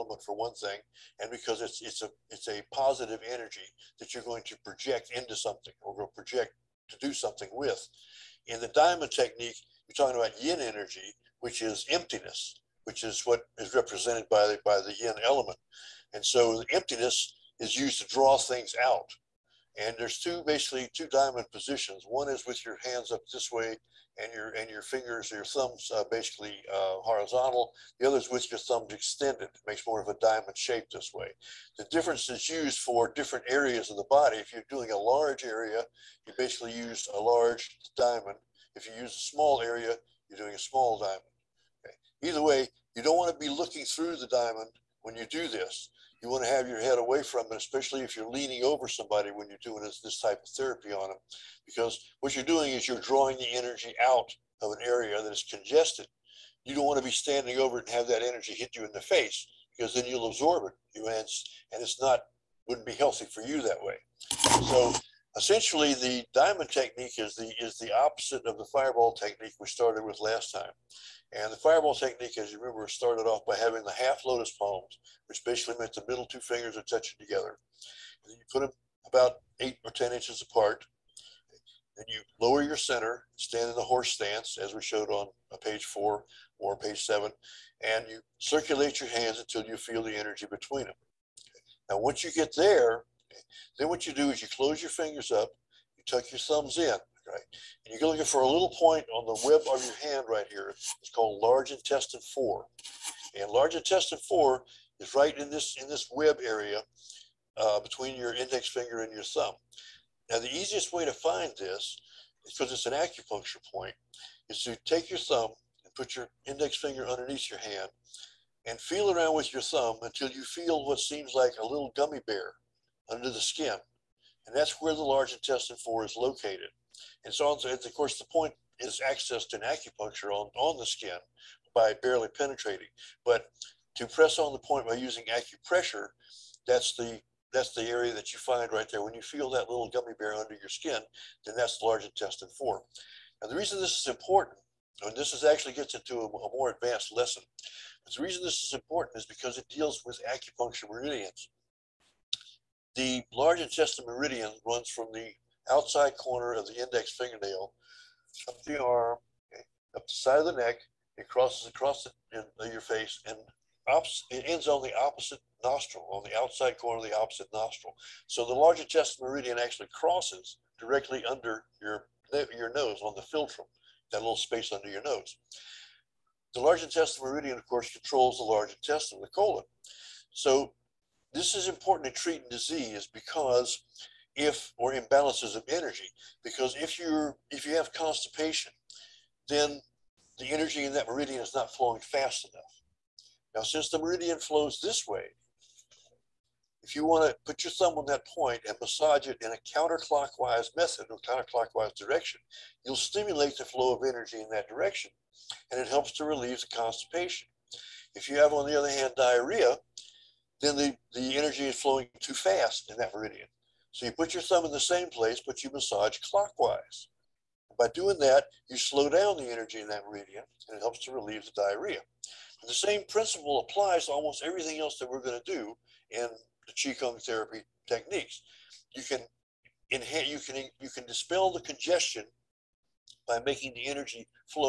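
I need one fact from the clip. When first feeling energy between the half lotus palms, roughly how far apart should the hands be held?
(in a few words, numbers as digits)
8 to 10 inches.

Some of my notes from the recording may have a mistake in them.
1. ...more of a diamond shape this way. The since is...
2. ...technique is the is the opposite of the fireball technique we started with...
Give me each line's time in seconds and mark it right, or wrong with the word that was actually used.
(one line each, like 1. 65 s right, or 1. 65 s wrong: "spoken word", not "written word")
1. 29 s wrong: "difference", not "since"
2. 66 s right.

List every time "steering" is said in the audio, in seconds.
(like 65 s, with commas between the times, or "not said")
not said.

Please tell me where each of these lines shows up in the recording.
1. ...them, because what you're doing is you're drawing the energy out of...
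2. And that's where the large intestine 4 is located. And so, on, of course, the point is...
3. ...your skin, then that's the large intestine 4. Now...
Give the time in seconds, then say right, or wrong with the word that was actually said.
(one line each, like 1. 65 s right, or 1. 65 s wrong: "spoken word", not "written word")
1. 51 s right
2. 124 s right
3. 140 s right.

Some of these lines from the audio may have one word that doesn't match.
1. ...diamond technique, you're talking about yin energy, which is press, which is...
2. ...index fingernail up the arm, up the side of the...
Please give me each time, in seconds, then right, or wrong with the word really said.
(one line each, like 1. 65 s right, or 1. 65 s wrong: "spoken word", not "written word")
1. 8 s wrong: "emptiness", not "press"
2. 156 s right.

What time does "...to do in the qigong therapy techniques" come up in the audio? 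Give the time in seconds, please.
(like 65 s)
225 s.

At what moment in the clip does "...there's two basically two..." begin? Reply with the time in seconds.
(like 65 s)
19 s.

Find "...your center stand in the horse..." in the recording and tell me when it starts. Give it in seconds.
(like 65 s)
82 s.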